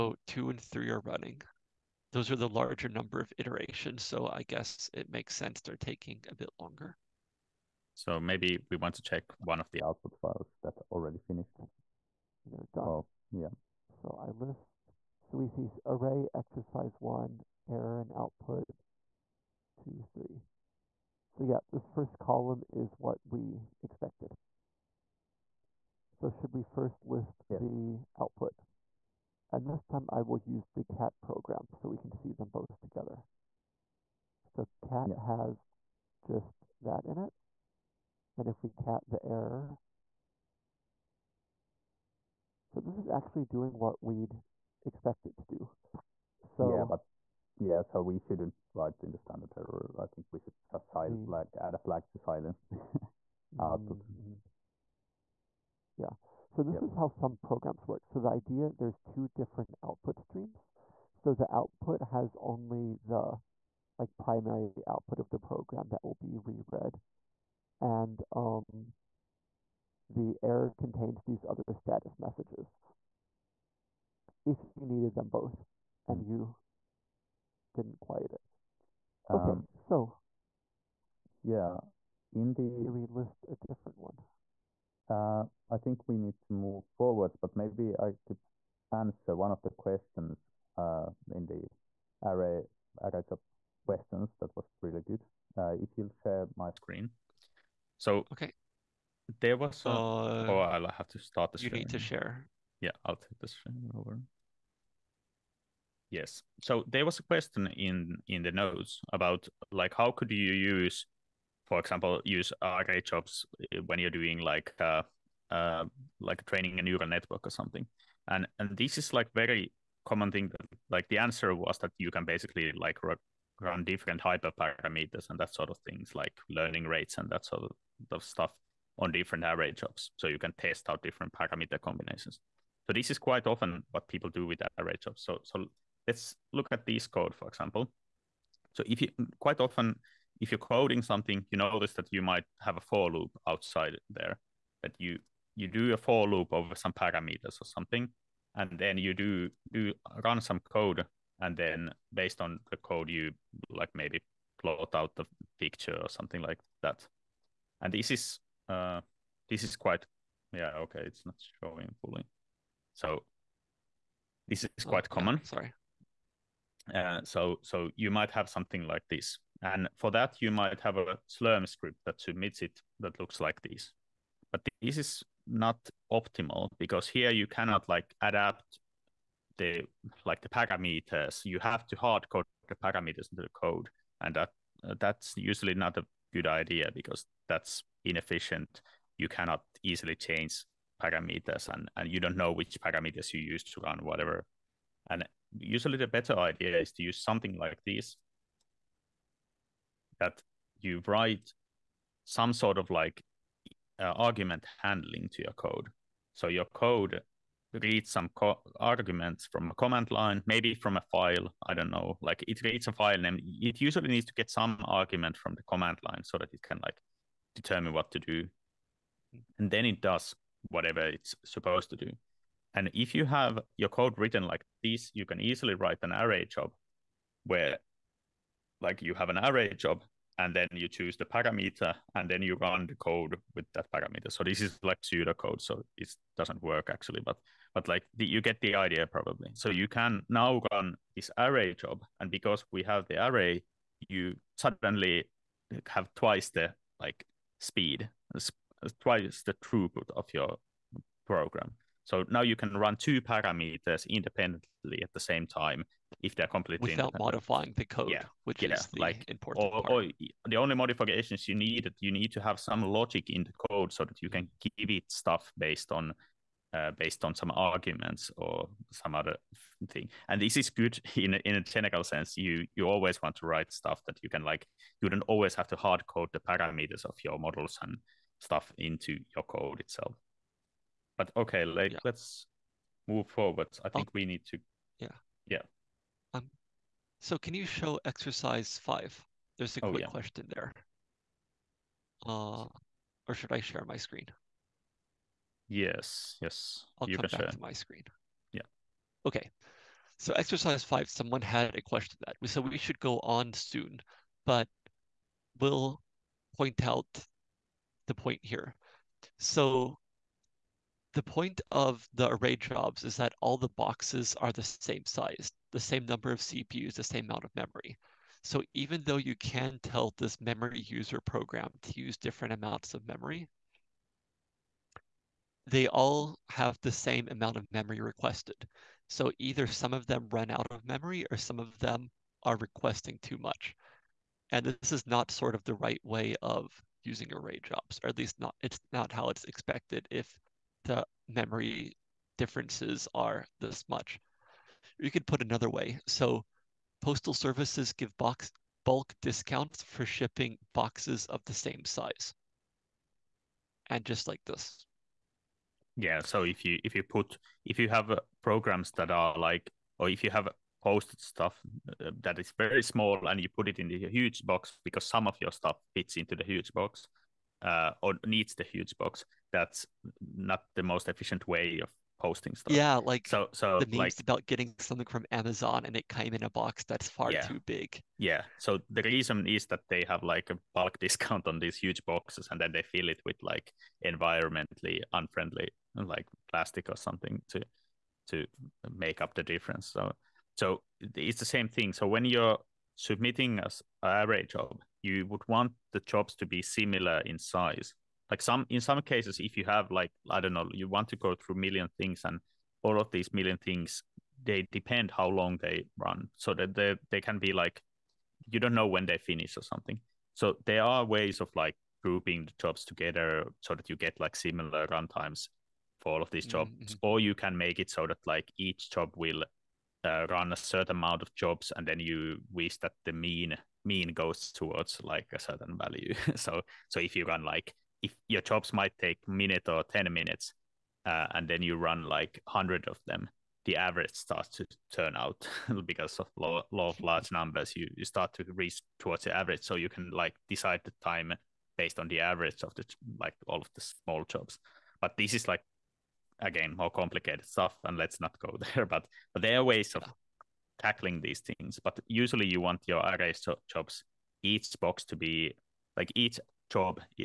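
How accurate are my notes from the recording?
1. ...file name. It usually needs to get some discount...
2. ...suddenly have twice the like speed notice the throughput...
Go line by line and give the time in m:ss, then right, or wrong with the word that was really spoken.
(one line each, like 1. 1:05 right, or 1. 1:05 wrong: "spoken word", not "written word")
1. 3:32 wrong: "argument", not "discount"
2. 4:04 wrong: "twice", not "notice".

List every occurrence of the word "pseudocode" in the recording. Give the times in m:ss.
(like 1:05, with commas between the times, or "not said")
3:55.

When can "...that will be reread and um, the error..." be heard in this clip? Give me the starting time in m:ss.
1:05.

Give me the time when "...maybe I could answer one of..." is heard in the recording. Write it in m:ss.
1:27.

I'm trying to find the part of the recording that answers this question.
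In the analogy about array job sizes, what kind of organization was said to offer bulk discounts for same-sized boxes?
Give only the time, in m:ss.
5:47.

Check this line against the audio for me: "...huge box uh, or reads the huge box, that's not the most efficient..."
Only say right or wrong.
wrong.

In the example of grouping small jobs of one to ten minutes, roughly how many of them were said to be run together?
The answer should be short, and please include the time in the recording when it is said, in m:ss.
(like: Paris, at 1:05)
100, at 7:12.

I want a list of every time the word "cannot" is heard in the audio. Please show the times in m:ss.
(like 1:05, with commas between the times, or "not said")
2:57, 3:09.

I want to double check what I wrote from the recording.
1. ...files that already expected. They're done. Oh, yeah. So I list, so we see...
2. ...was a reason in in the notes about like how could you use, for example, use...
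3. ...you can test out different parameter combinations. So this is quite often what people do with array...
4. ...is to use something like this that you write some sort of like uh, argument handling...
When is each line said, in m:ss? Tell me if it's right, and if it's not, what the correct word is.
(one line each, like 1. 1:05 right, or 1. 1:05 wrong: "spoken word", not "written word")
1. 0:10 wrong: "finished", not "expected"
2. 1:47 wrong: "question", not "reason"
3. 2:10 right
4. 3:16 right.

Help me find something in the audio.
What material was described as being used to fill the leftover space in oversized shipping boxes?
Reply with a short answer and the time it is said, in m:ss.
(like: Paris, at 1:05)
plastic, at 6:26.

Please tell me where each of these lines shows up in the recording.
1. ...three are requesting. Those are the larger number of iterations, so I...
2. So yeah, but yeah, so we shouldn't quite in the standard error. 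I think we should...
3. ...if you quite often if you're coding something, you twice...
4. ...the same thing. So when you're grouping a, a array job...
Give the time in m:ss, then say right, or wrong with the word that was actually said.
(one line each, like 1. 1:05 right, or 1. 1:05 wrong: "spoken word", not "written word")
1. 0:00 wrong: "running", not "requesting"
2. 0:46 wrong: "write", not "quite"
3. 2:18 wrong: "notice", not "twice"
4. 6:31 wrong: "submitting", not "grouping".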